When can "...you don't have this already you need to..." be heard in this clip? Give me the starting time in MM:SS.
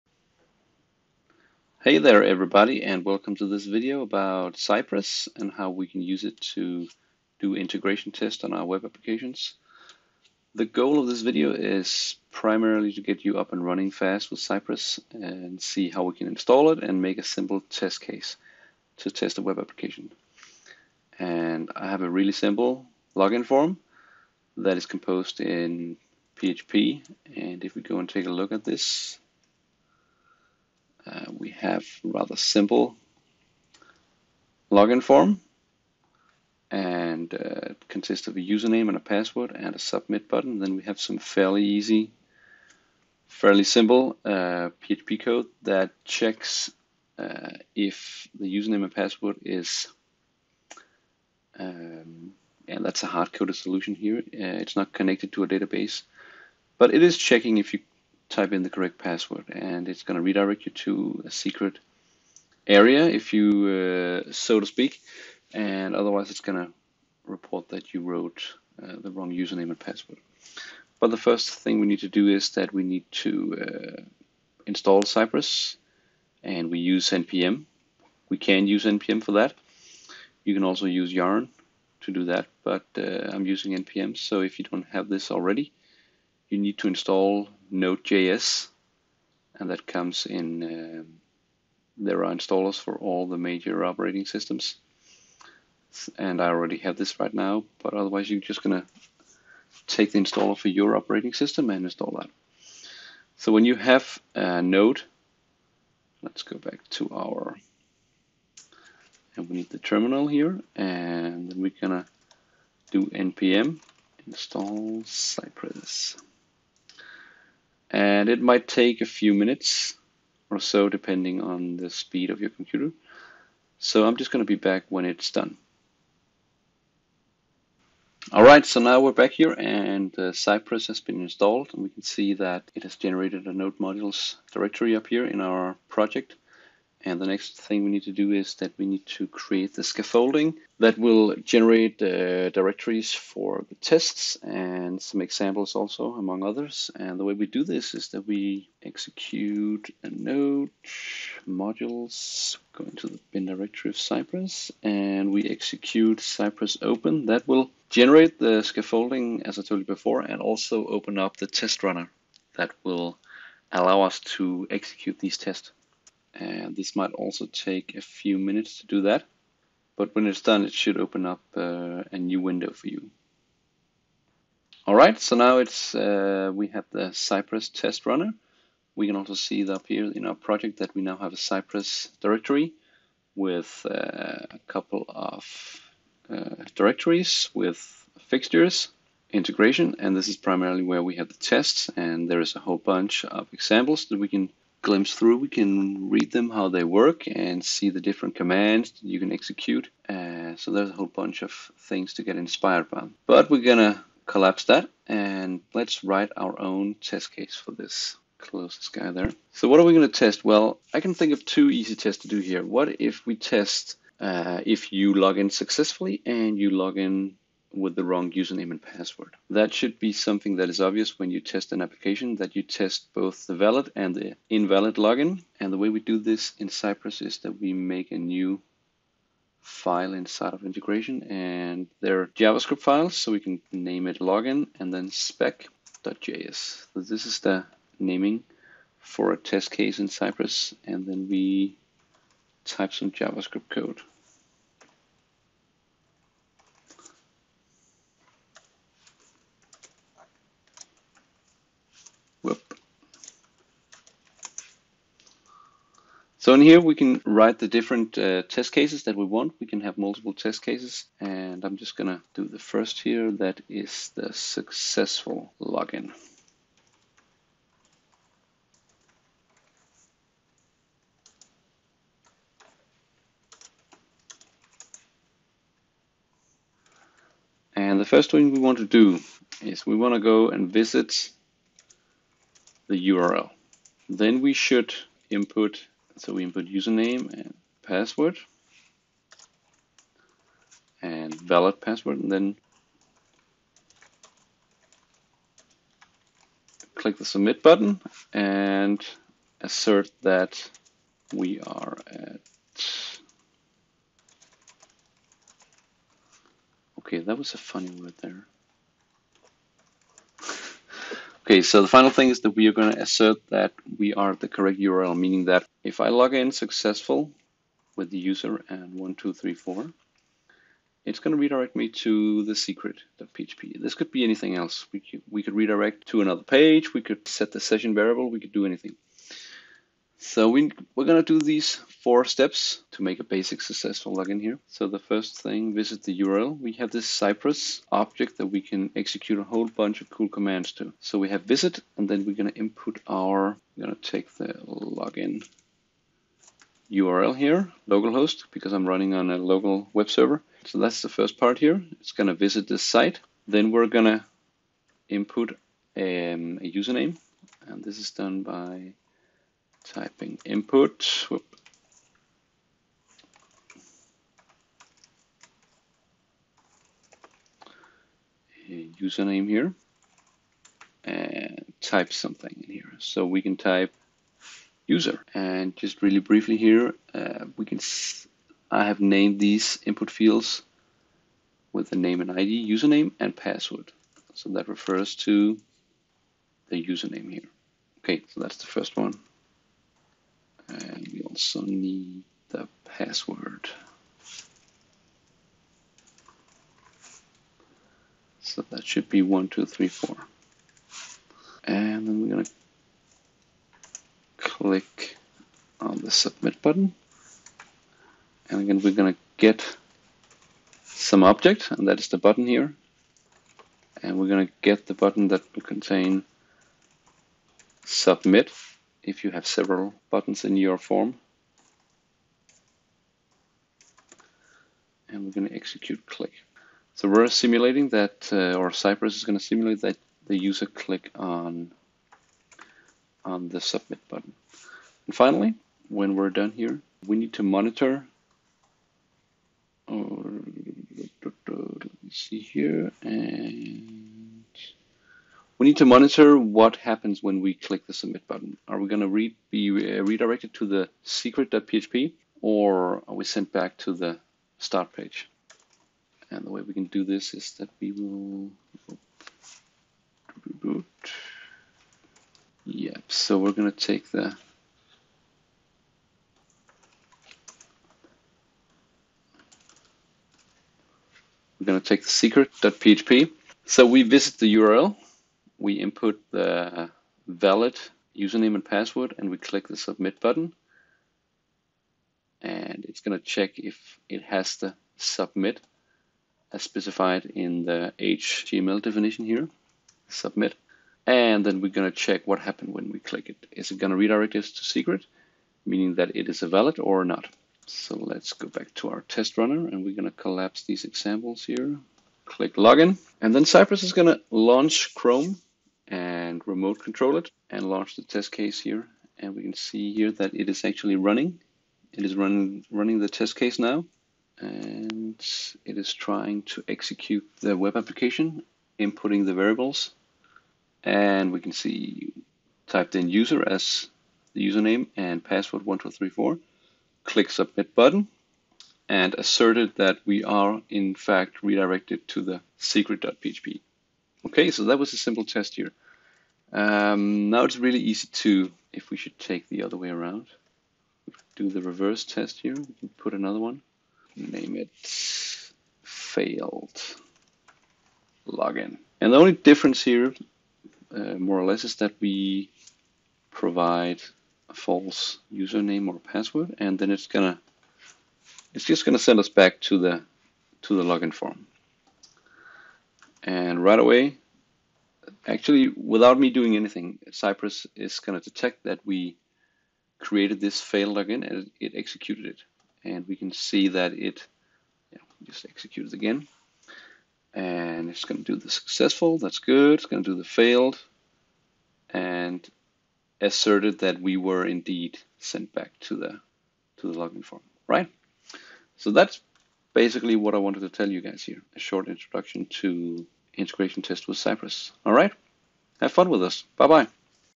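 01:24.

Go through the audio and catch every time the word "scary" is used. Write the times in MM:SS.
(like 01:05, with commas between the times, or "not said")
not said.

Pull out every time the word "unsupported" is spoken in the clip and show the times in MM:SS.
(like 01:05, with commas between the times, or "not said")
not said.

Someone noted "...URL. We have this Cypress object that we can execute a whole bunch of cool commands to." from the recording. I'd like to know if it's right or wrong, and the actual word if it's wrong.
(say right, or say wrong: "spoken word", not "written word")
right.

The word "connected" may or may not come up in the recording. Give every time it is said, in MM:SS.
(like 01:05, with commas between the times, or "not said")
00:54.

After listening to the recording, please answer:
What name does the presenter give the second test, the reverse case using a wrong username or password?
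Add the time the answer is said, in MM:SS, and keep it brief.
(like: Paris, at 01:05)
failed login, at 09:05.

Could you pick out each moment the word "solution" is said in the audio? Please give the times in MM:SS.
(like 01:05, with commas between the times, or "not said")
00:53.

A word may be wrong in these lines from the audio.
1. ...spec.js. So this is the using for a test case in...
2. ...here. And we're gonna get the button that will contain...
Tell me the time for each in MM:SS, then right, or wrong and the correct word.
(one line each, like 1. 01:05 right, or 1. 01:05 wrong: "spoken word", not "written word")
1. 03:55 wrong: "naming", not "using"
2. 06:52 right.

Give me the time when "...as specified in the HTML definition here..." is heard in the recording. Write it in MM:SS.
08:06.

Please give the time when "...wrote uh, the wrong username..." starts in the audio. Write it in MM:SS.
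01:08.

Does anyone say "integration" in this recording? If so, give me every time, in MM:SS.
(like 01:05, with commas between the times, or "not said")
00:07, 03:09, 03:50, 09:53.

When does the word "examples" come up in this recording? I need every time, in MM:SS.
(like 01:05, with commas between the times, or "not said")
02:25, 03:13, 08:20.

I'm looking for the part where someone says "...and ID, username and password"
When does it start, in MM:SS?
06:22.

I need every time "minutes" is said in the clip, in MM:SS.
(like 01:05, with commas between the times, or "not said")
01:59, 02:48.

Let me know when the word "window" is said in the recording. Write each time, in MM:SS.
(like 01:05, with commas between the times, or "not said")
02:52.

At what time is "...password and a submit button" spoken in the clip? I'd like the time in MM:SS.
00:39.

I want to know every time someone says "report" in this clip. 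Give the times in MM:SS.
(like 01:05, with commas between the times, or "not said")
01:07.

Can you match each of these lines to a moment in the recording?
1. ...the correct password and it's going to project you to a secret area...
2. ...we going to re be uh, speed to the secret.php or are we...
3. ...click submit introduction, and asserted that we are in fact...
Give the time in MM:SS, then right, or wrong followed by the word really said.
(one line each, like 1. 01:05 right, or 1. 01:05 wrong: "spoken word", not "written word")
1. 00:58 wrong: "redirect", not "project"
2. 07:28 wrong: "redirected", not "speed"
3. 08:47 wrong: "button", not "introduction".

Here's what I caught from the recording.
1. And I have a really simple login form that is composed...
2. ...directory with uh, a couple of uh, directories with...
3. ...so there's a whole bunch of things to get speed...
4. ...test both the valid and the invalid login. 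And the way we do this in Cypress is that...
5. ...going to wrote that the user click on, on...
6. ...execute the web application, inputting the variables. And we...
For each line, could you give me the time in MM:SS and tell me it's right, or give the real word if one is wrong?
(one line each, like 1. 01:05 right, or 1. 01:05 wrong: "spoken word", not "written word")
1. 00:21 right
2. 03:02 right
3. 03:20 wrong: "inspired", not "speed"
4. 03:42 right
5. 07:09 wrong: "simulate", not "wrote"
6. 08:36 right.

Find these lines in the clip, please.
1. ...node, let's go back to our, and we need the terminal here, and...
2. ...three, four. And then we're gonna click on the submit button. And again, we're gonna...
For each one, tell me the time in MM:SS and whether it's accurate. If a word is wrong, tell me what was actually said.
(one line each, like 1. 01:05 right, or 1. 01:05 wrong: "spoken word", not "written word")
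1. 01:44 right
2. 06:39 right.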